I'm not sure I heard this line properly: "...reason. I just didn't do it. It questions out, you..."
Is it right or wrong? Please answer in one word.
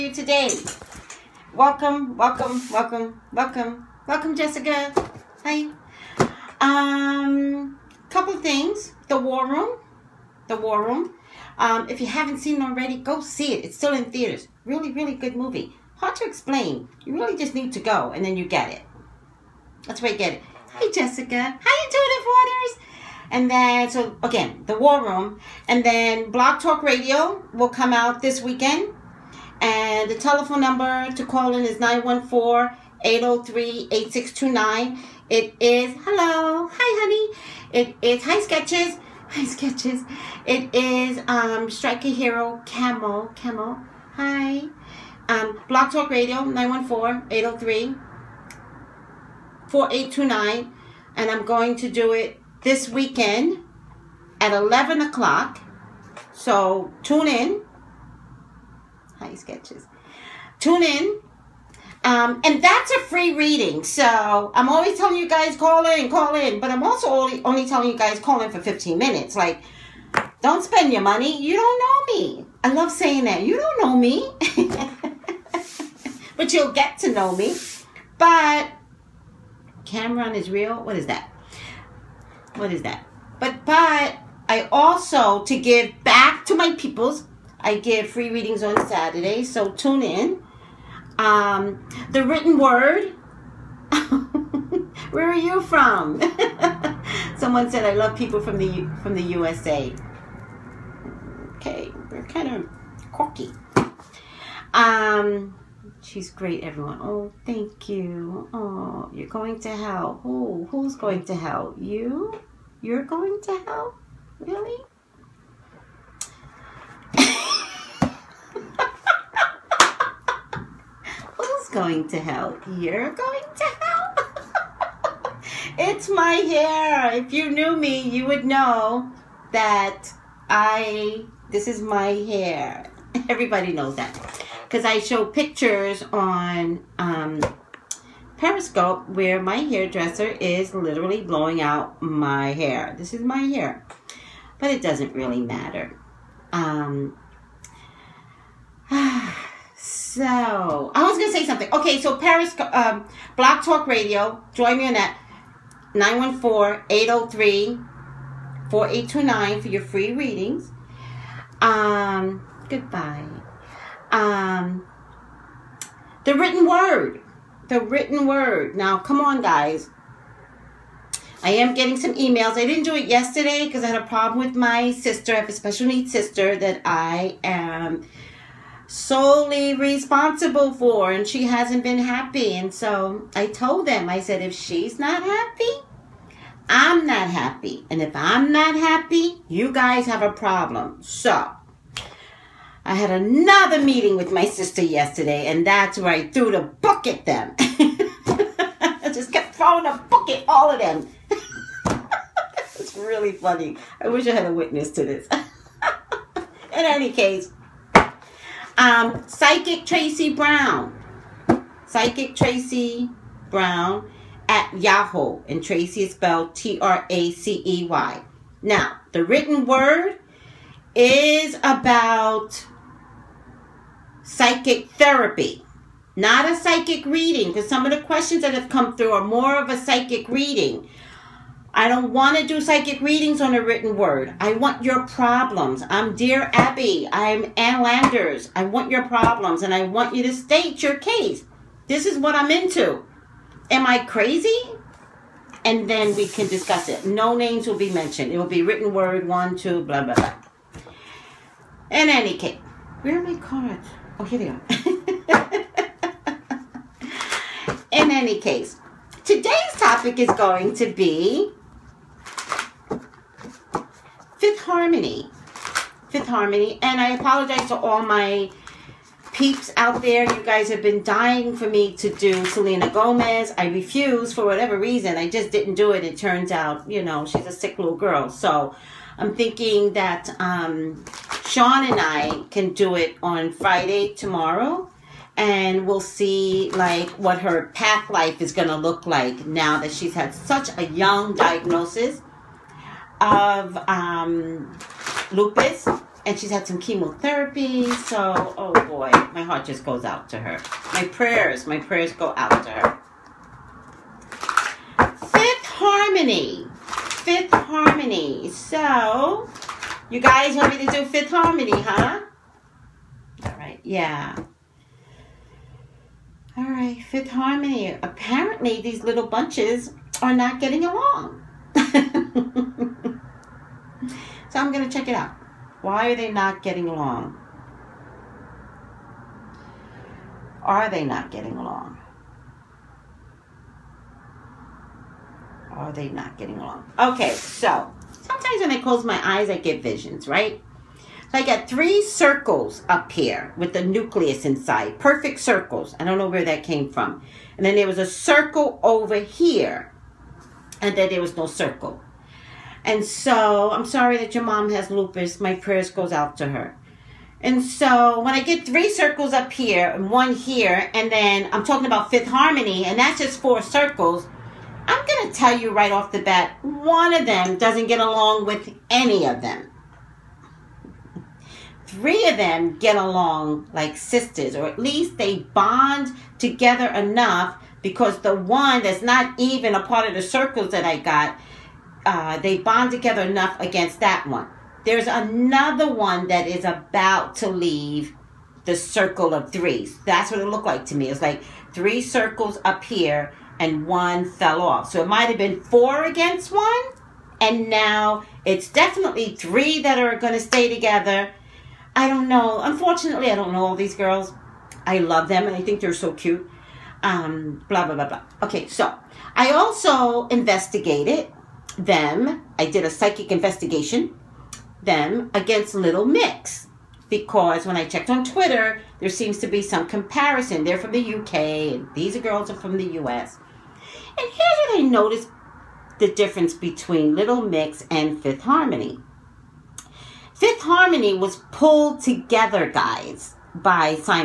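wrong.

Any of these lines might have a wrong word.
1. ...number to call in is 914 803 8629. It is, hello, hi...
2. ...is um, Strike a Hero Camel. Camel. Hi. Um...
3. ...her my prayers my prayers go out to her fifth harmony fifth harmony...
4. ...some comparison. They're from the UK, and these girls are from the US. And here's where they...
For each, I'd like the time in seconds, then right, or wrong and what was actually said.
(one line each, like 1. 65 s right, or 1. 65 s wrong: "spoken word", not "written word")
1. 30 s right
2. 40 s right
3. 300 s right
4. 419 s right.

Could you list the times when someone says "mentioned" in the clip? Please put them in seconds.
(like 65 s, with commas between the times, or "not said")
247 s.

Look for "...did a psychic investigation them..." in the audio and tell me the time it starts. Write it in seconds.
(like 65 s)
412 s.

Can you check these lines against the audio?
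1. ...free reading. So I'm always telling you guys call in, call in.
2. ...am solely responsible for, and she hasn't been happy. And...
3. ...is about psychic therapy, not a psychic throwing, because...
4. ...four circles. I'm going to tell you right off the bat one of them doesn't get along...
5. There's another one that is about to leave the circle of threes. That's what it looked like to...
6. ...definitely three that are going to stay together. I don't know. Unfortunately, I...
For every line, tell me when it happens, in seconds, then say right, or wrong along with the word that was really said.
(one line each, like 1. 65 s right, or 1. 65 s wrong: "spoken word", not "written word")
1. 63 s right
2. 177 s right
3. 220 s wrong: "reading", not "throwing"
4. 363 s right
5. 384 s right
6. 398 s right.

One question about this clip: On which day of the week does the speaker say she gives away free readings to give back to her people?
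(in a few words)
Saturday.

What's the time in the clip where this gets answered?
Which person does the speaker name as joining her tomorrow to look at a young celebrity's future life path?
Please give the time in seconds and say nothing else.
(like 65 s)
281 s.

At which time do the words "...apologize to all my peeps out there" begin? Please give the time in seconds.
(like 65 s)
267 s.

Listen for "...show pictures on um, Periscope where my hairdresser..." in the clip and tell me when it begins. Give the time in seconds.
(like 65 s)
134 s.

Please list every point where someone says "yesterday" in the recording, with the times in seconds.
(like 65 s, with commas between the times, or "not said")
173 s, 194 s.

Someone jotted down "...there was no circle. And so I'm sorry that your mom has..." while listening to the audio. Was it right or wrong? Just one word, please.
right.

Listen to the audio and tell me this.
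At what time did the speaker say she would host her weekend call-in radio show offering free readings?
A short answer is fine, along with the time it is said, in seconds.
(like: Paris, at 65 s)
11 o'clock, at 54 s.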